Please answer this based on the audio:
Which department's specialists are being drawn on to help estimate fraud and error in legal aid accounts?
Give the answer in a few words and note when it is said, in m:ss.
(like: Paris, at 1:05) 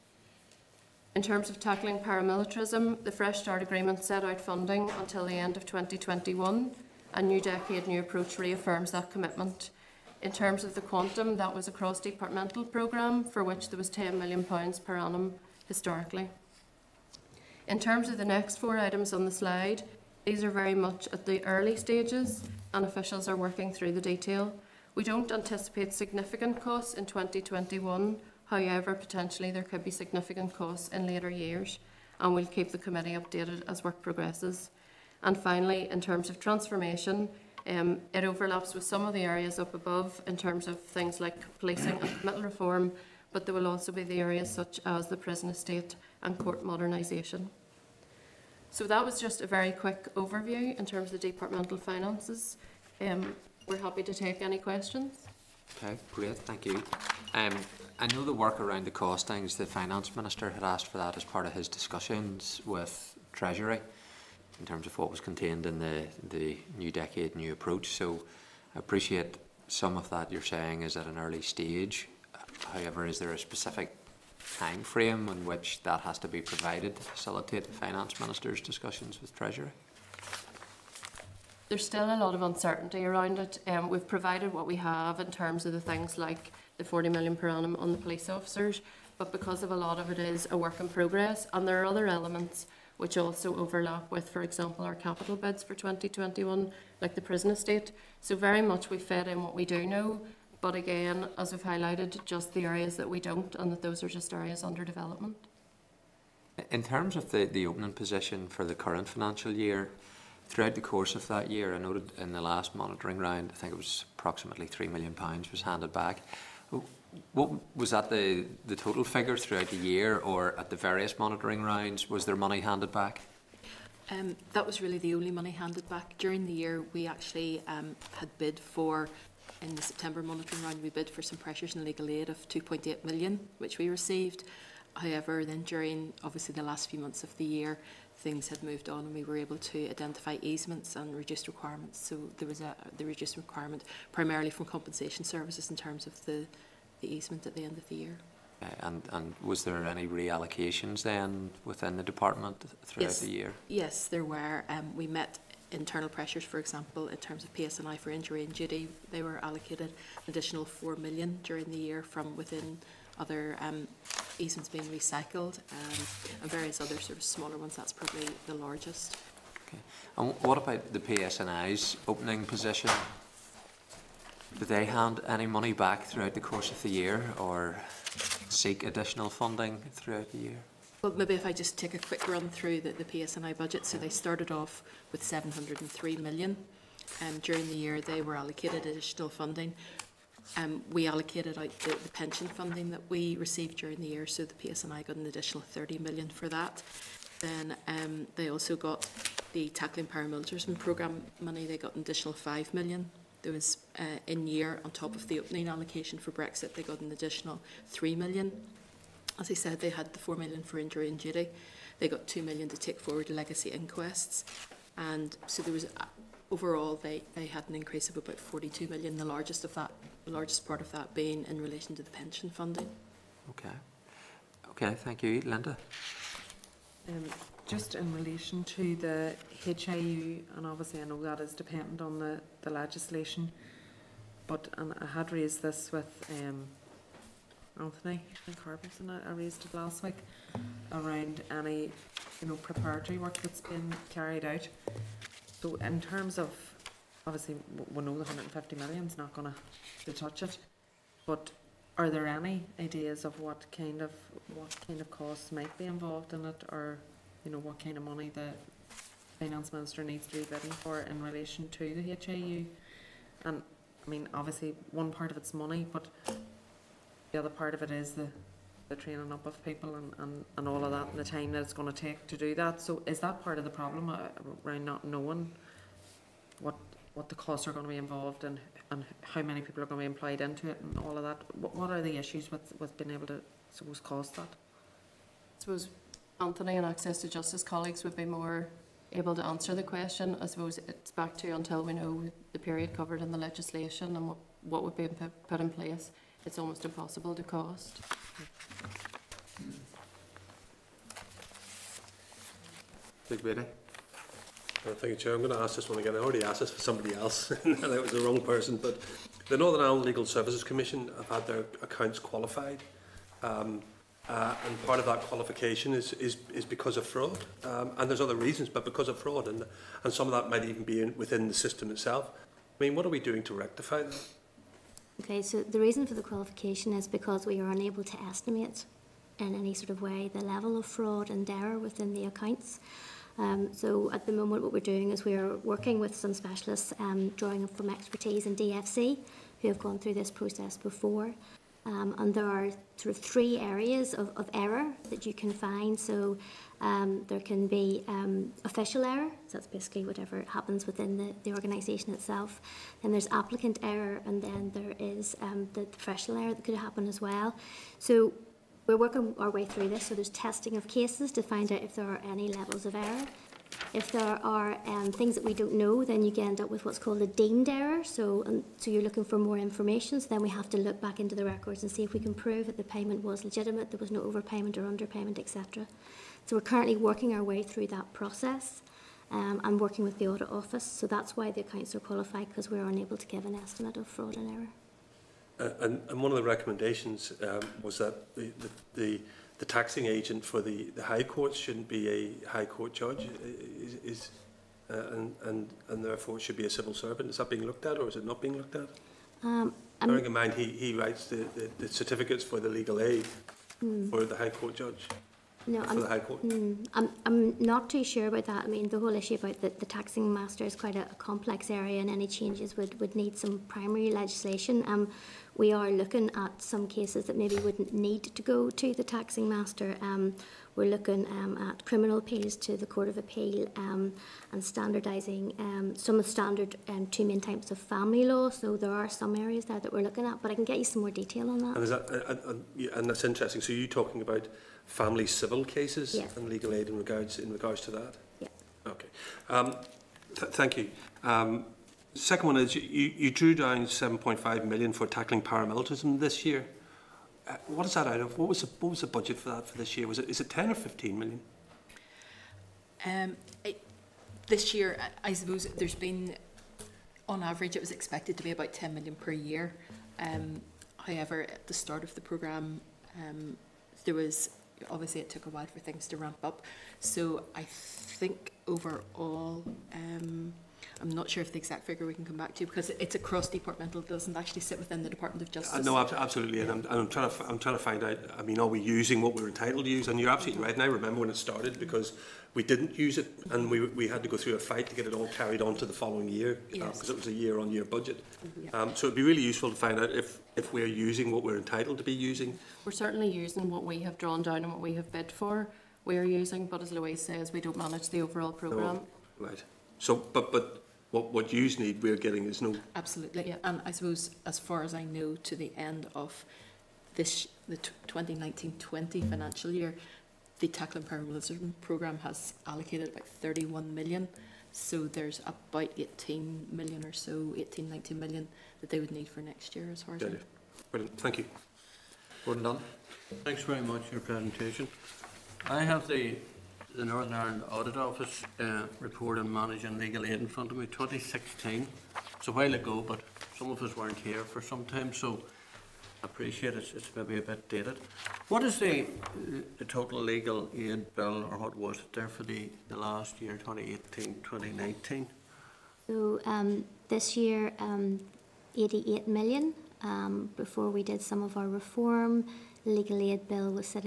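DFC, at 5:38.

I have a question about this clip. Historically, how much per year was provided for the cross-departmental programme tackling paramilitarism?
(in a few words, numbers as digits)
£10 million.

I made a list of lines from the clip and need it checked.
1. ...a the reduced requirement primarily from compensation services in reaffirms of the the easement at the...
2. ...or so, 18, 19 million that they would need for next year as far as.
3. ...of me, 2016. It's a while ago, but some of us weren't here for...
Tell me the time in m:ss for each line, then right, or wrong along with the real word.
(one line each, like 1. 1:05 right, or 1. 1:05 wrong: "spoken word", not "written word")
1. 2:22 wrong: "terms", not "reaffirms"
2. 8:37 right
3. 8:50 right.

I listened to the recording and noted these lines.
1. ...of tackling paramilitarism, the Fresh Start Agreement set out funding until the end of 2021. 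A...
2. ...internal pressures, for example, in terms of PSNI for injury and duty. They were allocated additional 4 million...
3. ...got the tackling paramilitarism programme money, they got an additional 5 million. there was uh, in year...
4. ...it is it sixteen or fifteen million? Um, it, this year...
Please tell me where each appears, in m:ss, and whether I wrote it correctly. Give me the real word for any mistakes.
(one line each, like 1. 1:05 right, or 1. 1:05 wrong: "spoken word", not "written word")
1. 0:01 right
2. 2:35 right
3. 3:18 right
4. 7:30 wrong: "ten", not "sixteen".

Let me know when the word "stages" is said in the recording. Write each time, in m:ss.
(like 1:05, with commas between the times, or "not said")
0:21, 1:11.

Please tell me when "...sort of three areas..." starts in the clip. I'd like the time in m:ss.
5:42.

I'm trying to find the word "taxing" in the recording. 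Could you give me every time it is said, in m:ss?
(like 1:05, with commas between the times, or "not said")
6:29, 6:49, 6:59.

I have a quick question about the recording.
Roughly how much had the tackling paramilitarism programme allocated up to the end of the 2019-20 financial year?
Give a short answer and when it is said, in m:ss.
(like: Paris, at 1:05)
31 million, at 8:33.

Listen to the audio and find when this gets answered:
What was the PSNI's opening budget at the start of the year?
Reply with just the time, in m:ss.
3:05.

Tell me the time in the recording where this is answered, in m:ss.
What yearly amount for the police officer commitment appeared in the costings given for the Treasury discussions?
1:26.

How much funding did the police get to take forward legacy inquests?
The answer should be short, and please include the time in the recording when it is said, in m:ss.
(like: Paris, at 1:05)
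2 million, at 3:32.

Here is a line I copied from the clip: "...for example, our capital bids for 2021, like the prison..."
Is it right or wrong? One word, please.
right.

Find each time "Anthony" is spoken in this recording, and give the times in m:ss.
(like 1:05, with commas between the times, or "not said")
3:57, 4:46.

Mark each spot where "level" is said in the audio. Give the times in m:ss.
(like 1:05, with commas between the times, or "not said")
5:30, 6:02.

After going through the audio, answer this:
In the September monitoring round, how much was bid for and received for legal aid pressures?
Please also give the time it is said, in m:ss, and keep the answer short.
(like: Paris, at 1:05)
2.8 million, at 2:12.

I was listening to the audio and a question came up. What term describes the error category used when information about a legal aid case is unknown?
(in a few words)
deemed error.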